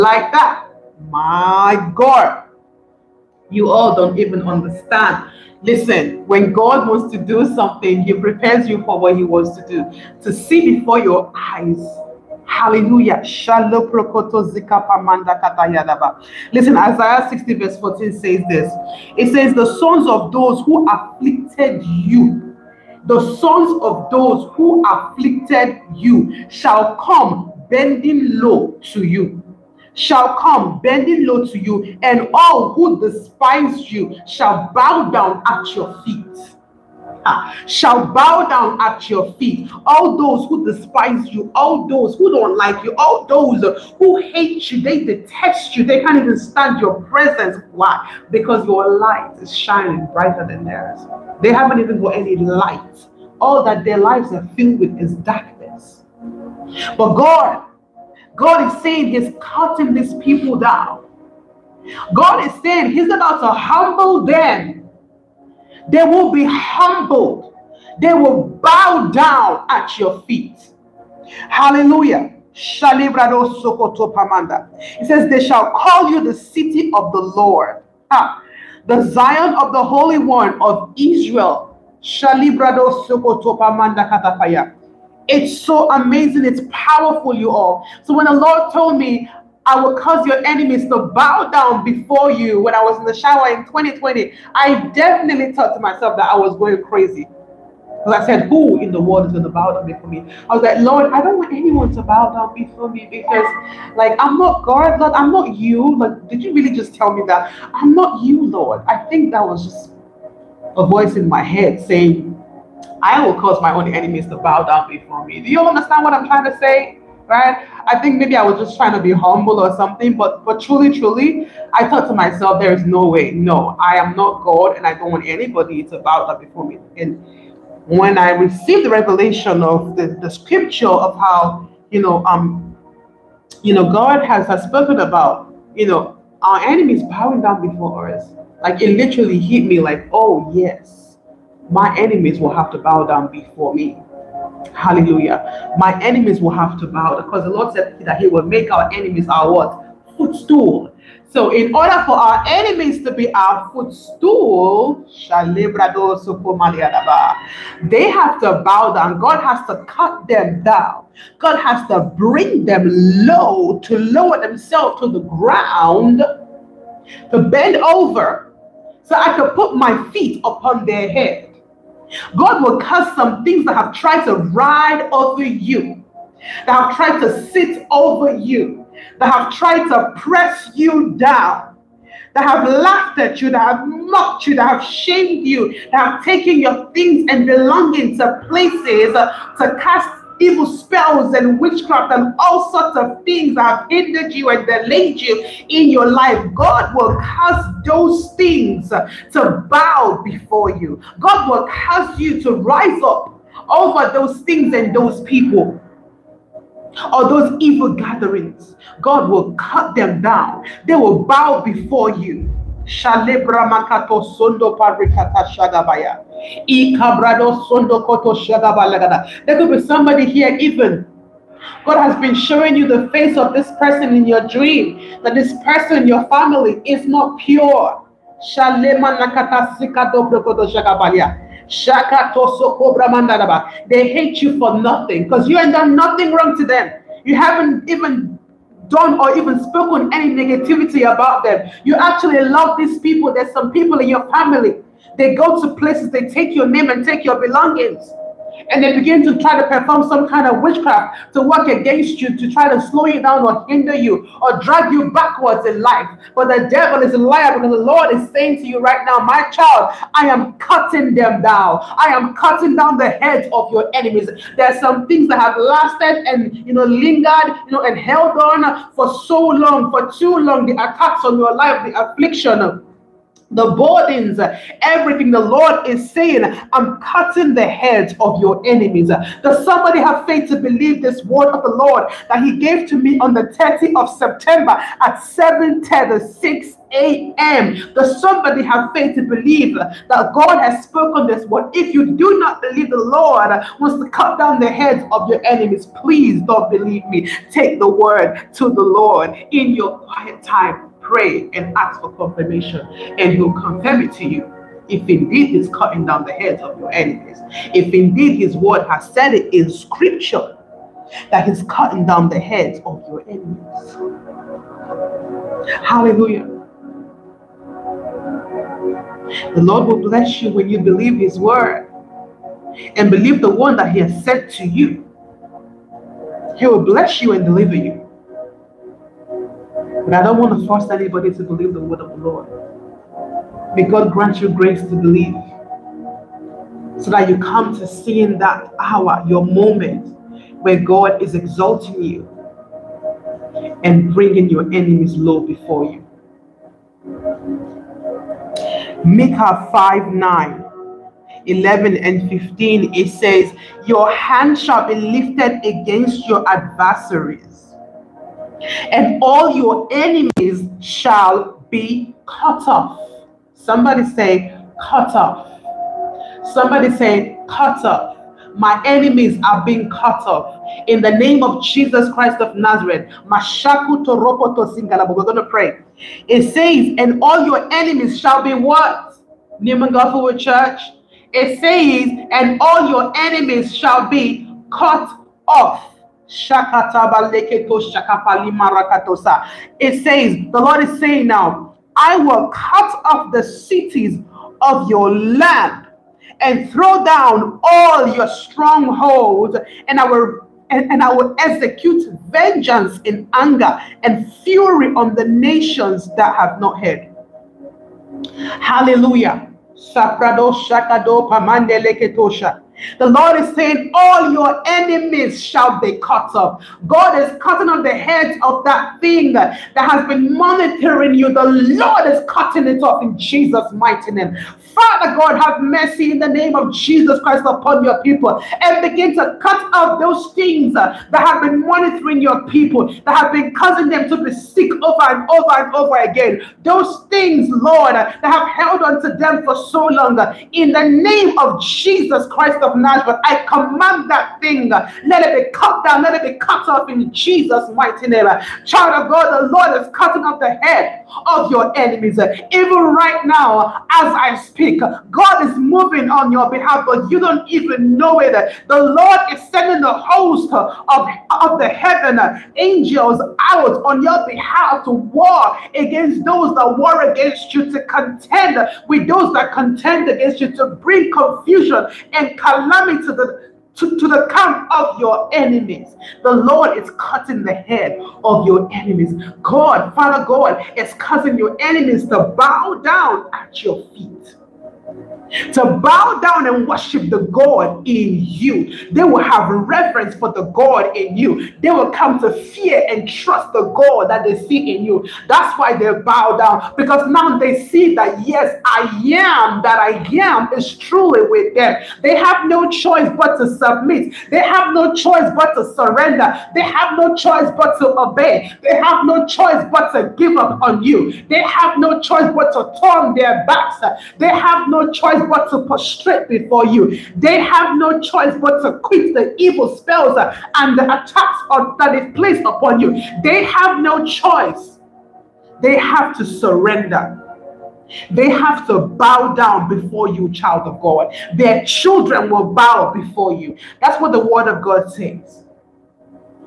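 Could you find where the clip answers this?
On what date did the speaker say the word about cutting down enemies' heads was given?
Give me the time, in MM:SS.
04:43.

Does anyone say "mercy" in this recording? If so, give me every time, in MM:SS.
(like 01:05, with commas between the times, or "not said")
07:05.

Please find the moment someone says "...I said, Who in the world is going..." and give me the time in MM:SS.
01:38.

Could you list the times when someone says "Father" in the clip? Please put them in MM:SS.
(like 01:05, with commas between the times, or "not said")
07:04, 07:59.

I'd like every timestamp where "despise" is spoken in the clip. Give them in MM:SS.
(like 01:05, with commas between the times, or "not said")
00:33, 00:40.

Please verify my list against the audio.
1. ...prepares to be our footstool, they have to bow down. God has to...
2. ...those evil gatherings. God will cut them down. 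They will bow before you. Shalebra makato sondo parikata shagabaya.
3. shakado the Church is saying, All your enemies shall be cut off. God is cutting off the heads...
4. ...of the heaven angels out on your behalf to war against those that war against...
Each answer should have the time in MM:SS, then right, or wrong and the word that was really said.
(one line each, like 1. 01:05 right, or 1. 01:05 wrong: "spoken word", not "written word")
1. 02:32 wrong: "enemies", not "prepares"
2. 03:27 right
3. 06:49 wrong: "Lord", not "Church"
4. 07:41 right.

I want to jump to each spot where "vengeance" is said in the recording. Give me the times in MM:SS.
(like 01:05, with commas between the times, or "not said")
06:42.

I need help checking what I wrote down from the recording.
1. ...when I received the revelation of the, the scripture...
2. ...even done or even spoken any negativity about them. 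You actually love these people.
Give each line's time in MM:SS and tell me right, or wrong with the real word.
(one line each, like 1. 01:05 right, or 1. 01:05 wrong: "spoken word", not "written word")
1. 02:07 right
2. 03:57 right.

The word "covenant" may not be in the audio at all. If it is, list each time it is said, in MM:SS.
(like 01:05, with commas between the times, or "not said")
not said.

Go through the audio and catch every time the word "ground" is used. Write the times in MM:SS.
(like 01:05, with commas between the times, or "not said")
02:45.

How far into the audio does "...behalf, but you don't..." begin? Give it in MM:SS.
07:36.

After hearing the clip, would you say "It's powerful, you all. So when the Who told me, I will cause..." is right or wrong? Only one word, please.
wrong.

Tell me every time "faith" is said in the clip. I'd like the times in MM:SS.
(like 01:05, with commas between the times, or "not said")
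04:40, 04:48.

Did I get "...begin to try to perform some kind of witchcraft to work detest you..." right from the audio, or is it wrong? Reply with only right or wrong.
wrong.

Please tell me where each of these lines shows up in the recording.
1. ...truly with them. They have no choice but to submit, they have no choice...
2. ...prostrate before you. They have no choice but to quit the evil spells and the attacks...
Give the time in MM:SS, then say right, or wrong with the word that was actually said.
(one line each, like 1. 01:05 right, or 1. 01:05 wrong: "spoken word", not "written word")
1. 08:20 right
2. 08:35 right.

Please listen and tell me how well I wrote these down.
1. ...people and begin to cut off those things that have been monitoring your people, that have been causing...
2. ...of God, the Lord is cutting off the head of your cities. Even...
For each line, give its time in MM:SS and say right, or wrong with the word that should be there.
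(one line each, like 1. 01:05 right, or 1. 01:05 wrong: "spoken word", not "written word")
1. 07:08 right
2. 07:29 wrong: "enemies", not "cities".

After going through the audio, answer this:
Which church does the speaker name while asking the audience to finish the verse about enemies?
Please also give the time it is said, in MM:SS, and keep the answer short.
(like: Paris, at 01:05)
Newman Gopherwood Church, at 06:19.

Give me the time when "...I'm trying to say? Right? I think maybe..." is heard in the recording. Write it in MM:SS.
01:56.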